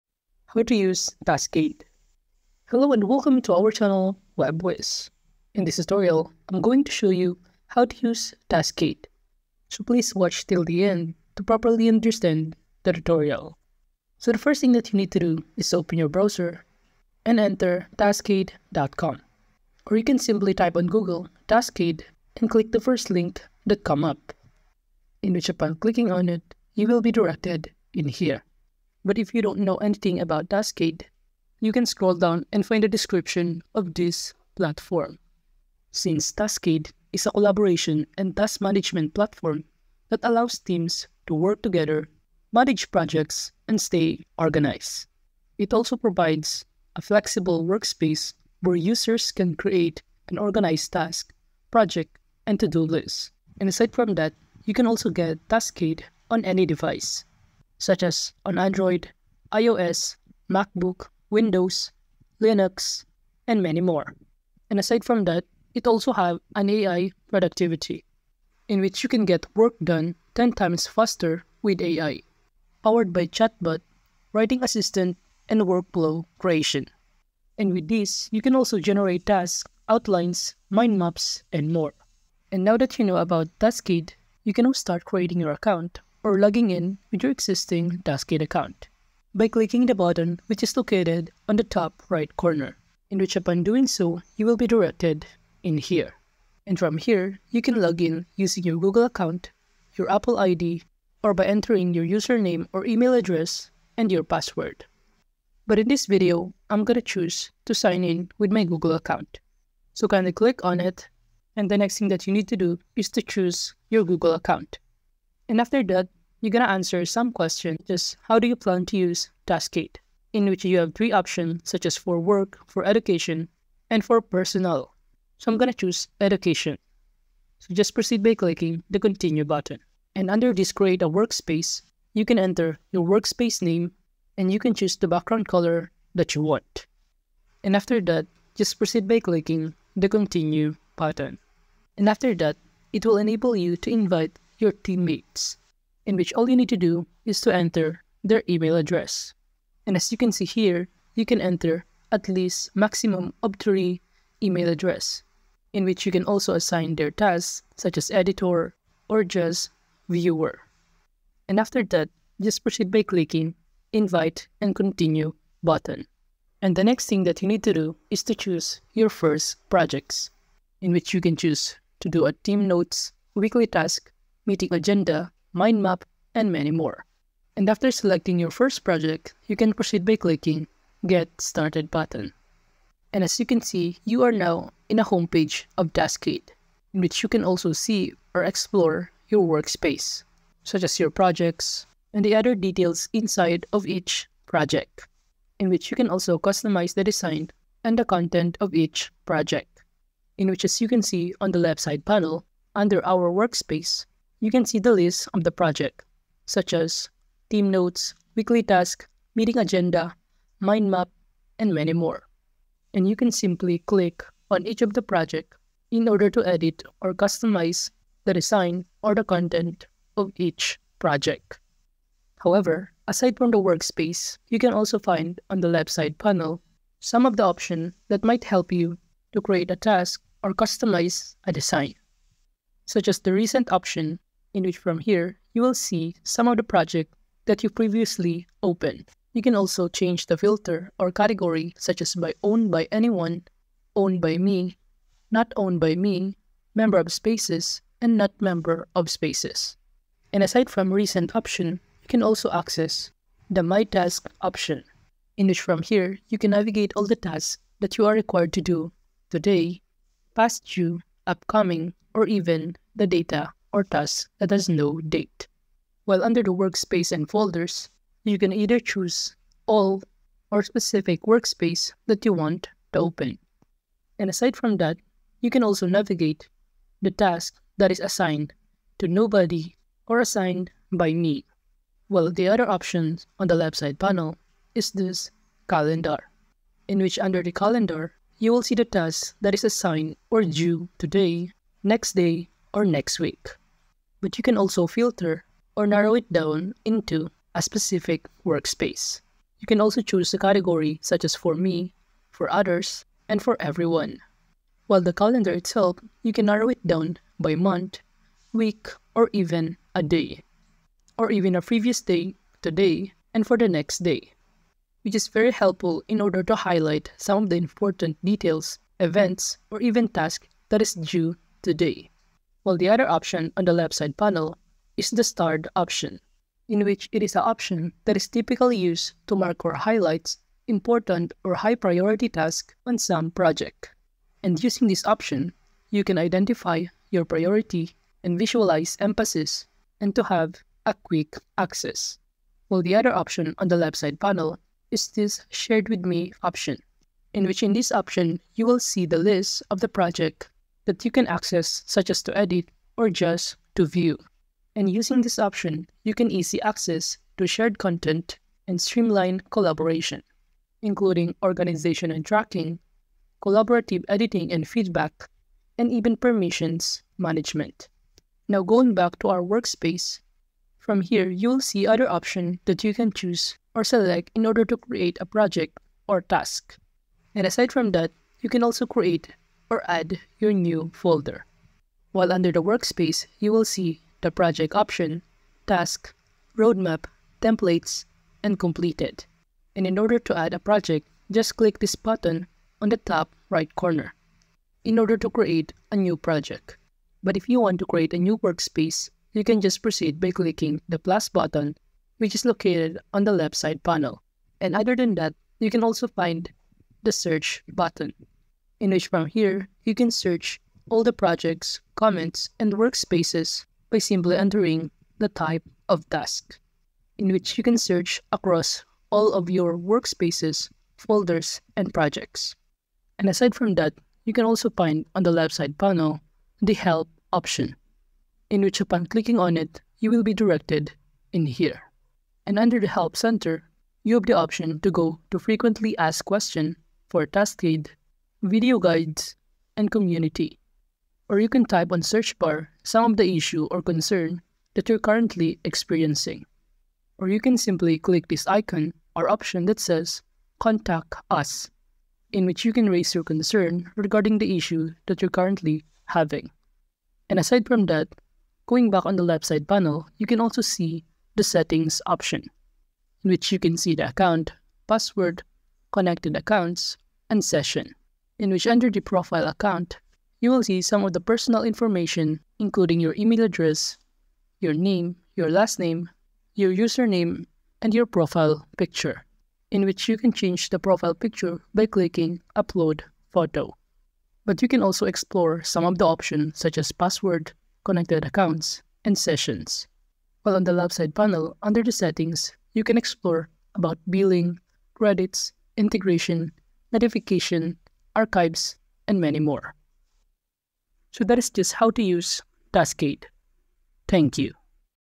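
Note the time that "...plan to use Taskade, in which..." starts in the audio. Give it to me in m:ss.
1:58.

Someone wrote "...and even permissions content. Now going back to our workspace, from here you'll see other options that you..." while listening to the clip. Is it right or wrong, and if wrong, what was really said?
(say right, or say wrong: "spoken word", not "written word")
wrong: "management", not "content".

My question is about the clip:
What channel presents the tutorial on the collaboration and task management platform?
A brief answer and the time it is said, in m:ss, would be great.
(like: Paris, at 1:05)
Web Whizz, at 0:04.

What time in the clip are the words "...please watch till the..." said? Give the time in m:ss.
0:09.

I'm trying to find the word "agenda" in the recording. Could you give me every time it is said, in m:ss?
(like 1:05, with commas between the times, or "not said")
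2:54, 3:29.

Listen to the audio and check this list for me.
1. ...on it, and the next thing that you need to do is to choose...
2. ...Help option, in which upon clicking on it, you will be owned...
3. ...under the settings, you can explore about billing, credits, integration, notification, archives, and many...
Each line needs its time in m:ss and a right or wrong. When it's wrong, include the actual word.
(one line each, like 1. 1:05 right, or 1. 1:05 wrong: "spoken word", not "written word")
1. 1:50 right
2. 7:06 wrong: "directed", not "owned"
3. 8:11 right.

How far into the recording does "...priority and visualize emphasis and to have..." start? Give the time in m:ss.
5:37.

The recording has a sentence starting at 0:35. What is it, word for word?
Since Taskade is a collaboration and task management platform that allows teams to work together, manage projects, and stay organized.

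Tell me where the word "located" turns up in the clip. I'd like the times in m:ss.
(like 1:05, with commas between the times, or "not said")
1:30, 6:42.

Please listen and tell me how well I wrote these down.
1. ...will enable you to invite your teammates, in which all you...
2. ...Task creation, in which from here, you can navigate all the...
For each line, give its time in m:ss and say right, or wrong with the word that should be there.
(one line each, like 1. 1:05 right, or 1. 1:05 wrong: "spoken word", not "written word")
1. 2:23 right
2. 4:13 wrong: "option", not "creation".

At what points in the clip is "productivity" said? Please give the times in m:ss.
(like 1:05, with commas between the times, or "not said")
1:07.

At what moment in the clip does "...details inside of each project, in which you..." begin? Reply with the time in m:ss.
3:12.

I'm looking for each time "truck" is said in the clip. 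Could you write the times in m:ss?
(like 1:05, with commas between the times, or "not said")
not said.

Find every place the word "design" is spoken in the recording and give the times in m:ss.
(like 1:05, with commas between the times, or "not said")
3:17, 3:38, 3:51.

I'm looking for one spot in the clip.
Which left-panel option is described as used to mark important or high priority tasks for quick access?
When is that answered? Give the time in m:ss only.
5:25.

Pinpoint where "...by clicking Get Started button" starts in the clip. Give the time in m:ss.
3:00.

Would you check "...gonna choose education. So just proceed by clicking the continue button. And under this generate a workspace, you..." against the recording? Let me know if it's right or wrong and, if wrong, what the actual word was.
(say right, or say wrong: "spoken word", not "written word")
wrong: "create", not "generate".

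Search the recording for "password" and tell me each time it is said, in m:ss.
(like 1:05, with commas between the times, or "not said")
1:44, 7:44, 8:06.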